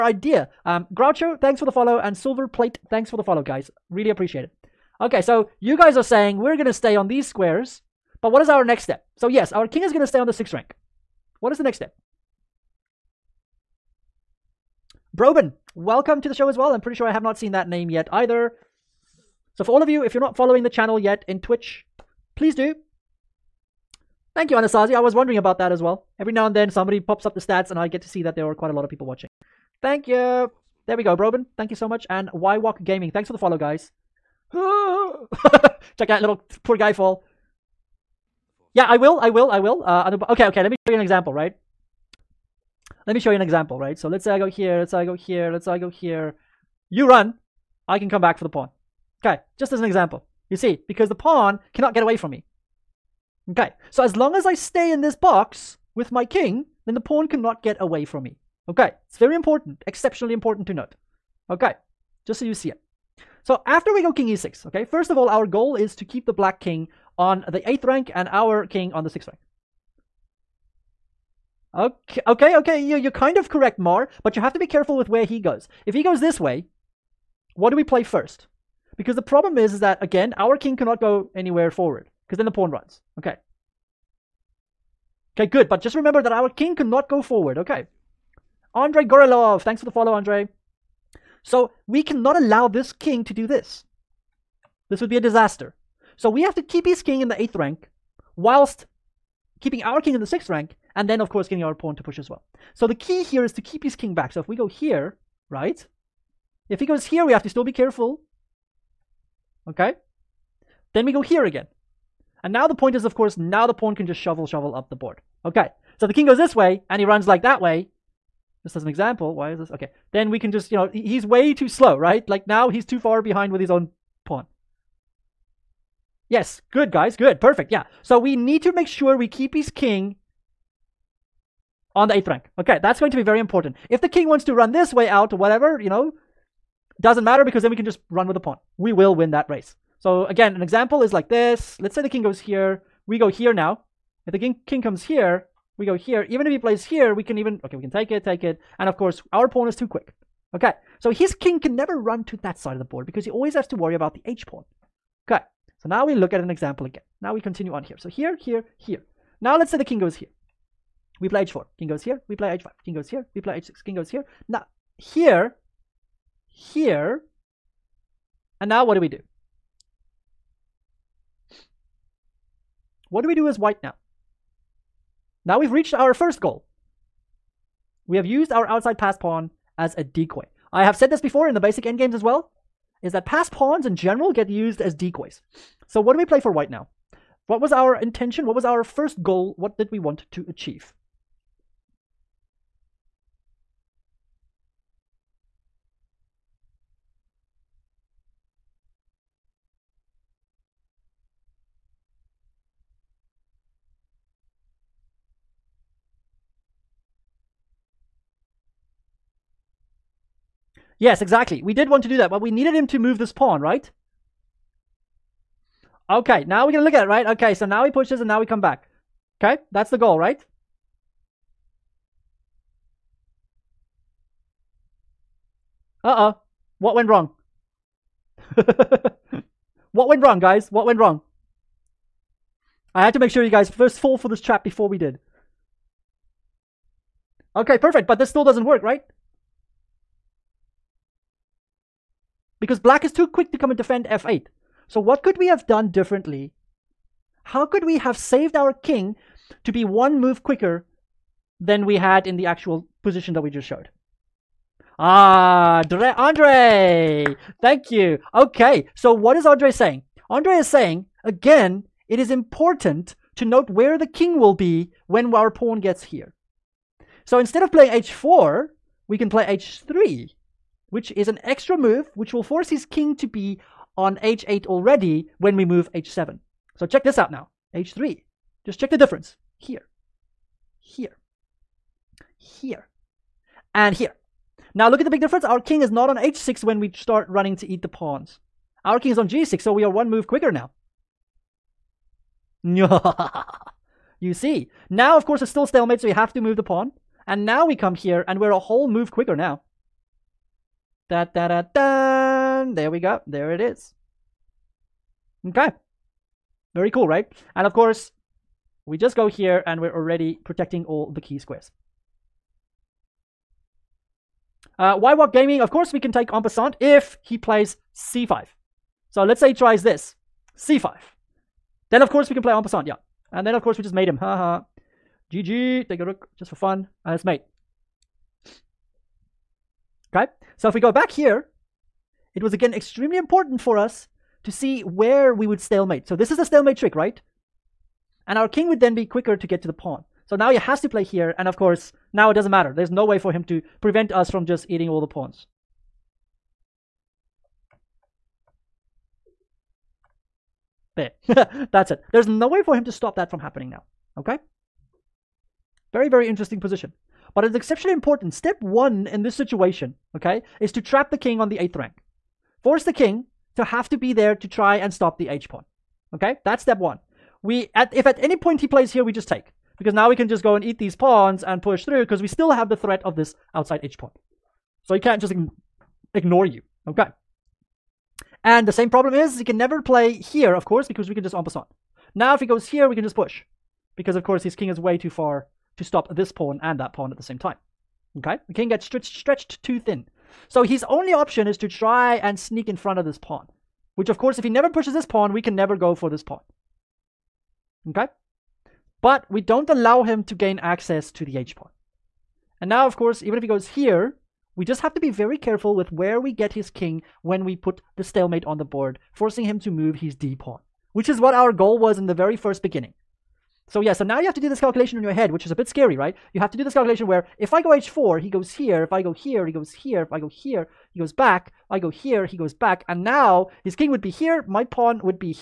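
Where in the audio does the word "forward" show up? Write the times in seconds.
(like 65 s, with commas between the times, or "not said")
81 s, 87 s.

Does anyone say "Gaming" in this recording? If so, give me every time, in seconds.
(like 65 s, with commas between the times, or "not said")
32 s, 315 s.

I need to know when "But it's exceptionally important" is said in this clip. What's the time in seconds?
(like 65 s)
357 s.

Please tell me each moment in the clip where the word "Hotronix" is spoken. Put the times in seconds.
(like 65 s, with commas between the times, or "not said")
not said.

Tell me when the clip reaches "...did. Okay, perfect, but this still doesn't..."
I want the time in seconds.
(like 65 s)
234 s.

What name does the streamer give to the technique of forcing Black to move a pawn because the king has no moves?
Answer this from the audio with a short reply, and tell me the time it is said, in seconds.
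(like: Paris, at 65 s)
Stalemate trick, at 336 s.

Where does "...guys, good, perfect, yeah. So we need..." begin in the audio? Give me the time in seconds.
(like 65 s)
126 s.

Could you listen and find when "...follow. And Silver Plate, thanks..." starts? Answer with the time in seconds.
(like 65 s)
1 s.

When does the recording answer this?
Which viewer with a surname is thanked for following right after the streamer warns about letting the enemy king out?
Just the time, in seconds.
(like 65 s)
88 s.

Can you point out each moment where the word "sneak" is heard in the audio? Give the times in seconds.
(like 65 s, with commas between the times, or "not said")
392 s.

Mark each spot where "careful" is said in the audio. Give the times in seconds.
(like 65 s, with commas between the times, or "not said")
74 s, 107 s, 405 s.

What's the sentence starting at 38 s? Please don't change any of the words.
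Yeah, I will, I will, I will.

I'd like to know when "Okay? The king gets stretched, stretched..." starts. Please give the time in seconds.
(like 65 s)
388 s.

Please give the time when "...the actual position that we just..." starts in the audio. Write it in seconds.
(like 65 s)
252 s.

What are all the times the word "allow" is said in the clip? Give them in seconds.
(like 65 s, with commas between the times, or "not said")
92 s, 399 s.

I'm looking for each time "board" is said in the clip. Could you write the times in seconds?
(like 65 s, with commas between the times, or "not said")
114 s, 152 s, 408 s.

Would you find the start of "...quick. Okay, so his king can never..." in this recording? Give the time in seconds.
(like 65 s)
149 s.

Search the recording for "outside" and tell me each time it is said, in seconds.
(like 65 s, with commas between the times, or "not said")
178 s, 373 s.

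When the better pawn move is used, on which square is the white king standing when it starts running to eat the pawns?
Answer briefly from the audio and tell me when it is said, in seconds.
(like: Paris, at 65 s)
g6, at 289 s.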